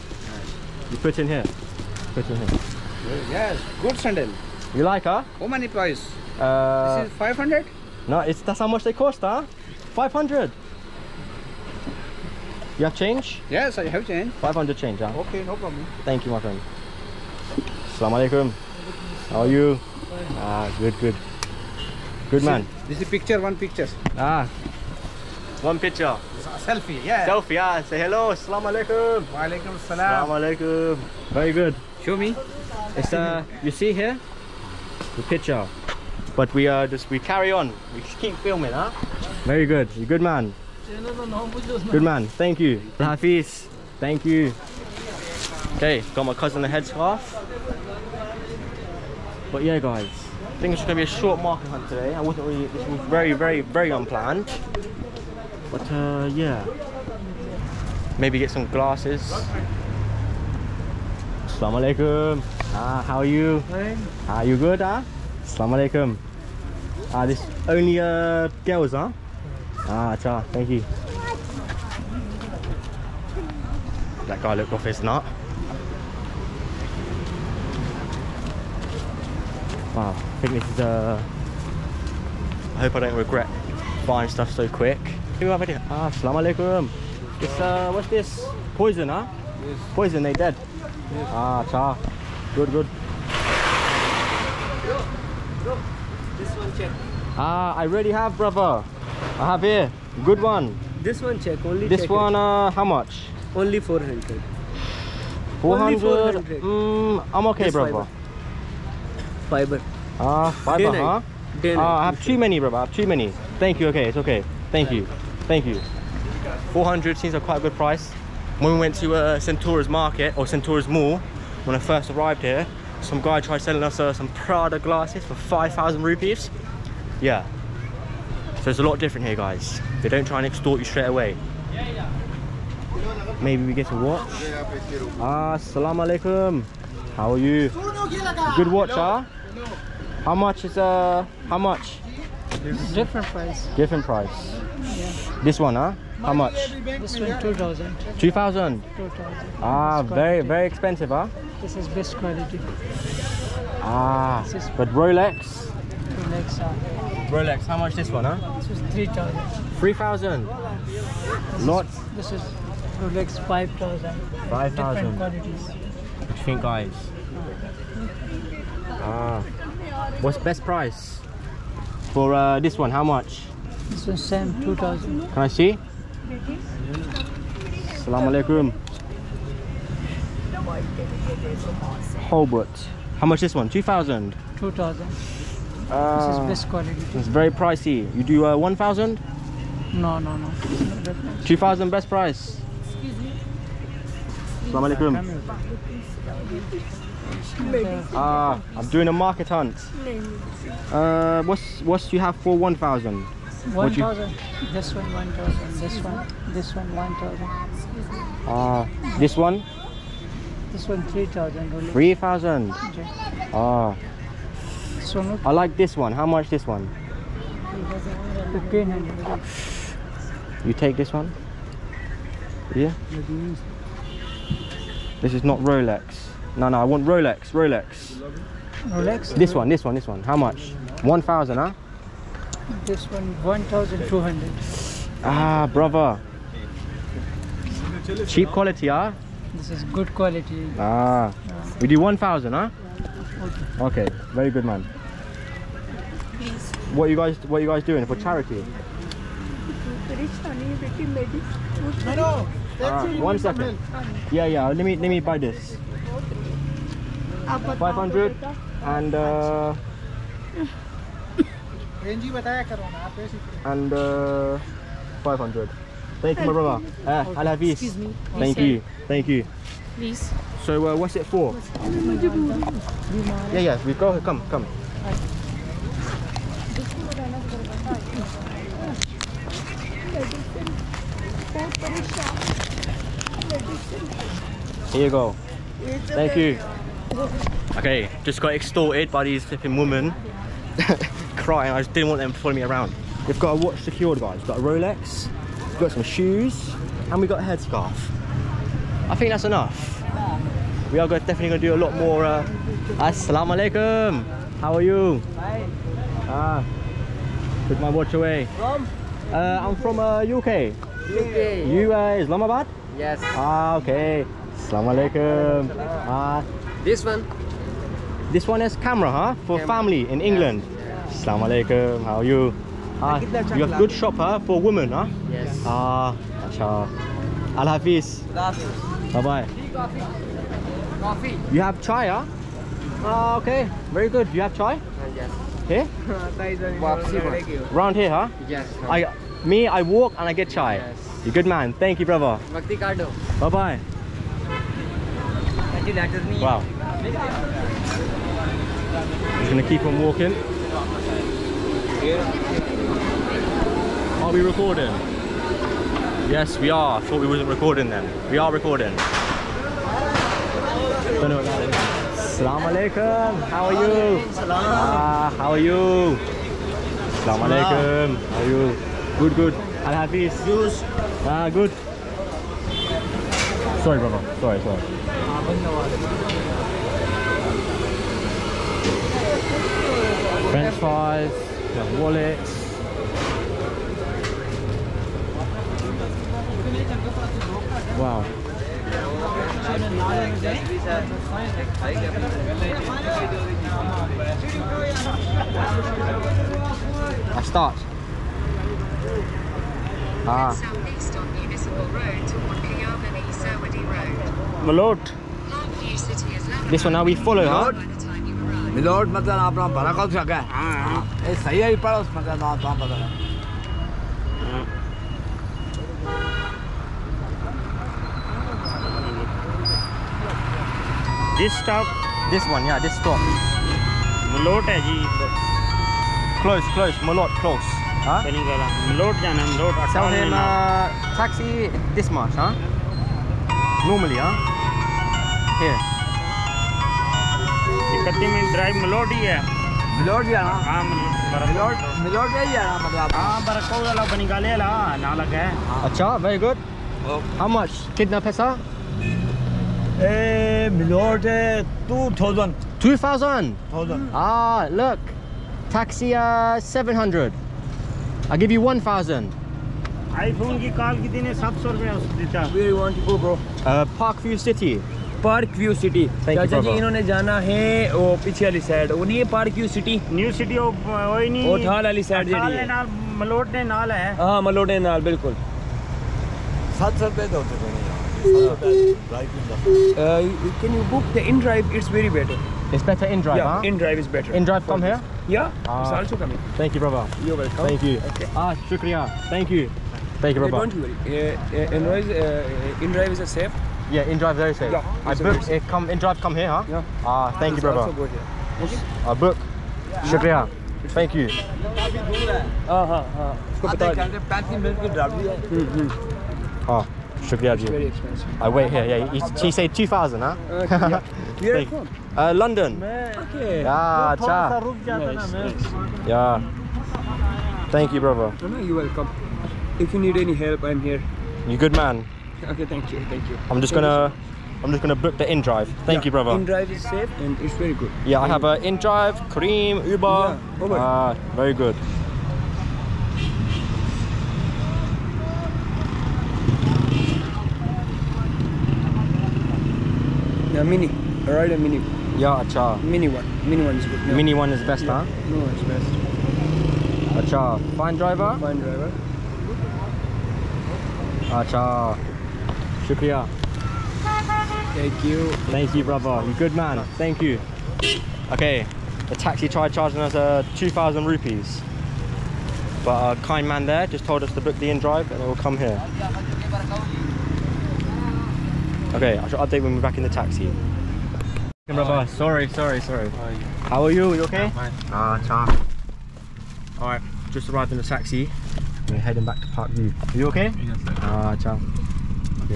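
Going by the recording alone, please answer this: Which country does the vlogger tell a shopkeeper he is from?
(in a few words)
UK.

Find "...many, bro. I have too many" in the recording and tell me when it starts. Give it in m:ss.
1:52.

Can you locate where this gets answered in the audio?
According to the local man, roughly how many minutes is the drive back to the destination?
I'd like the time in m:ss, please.
8:24.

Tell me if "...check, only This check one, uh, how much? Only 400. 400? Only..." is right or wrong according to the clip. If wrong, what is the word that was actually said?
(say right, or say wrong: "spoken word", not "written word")
right.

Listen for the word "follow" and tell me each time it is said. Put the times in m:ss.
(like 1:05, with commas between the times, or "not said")
4:52, 6:47.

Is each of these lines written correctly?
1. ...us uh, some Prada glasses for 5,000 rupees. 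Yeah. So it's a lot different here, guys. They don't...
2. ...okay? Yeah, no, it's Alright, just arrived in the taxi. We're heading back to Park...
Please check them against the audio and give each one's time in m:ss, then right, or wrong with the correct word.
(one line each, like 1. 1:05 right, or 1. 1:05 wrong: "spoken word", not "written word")
1. 2:03 right
2. 9:34 right.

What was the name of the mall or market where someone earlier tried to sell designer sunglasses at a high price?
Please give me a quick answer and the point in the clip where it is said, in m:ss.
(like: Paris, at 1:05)
Centaurus Mall, at 2:00.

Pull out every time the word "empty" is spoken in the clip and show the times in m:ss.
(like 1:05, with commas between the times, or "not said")
5:45.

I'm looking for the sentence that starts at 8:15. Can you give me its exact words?
Uh, come inDrive, come here, huh?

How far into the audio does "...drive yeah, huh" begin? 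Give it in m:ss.
8:03.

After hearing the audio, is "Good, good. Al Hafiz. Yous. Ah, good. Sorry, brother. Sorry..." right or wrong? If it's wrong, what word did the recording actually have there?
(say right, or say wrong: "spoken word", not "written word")
right.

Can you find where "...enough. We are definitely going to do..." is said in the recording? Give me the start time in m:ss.
4:59.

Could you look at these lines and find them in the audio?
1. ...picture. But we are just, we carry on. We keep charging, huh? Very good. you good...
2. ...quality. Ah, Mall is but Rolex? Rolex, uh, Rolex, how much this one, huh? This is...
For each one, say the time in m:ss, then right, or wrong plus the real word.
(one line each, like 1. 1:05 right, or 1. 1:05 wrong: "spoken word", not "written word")
1. 0:35 wrong: "filming", not "charging"
2. 2:32 wrong: "This", not "Mall".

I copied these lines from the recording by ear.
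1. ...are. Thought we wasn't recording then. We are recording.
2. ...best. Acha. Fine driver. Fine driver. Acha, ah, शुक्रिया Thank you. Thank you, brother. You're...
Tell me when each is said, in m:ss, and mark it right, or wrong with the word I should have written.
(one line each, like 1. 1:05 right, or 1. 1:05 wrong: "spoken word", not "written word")
1. 5:56 right
2. 9:05 right.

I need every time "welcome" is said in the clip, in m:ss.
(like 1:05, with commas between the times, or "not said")
8:07, 8:38.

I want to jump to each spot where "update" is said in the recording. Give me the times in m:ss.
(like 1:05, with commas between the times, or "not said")
9:29.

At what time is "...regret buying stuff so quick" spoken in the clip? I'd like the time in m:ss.
1:23.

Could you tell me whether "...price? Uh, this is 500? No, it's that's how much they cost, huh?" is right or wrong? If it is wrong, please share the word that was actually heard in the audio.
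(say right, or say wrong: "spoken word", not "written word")
right.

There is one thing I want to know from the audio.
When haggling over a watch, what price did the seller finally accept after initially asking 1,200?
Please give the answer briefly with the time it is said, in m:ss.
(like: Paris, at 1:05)
1,000, at 4:01.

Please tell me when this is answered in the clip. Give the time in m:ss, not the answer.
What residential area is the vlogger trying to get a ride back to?
7:44.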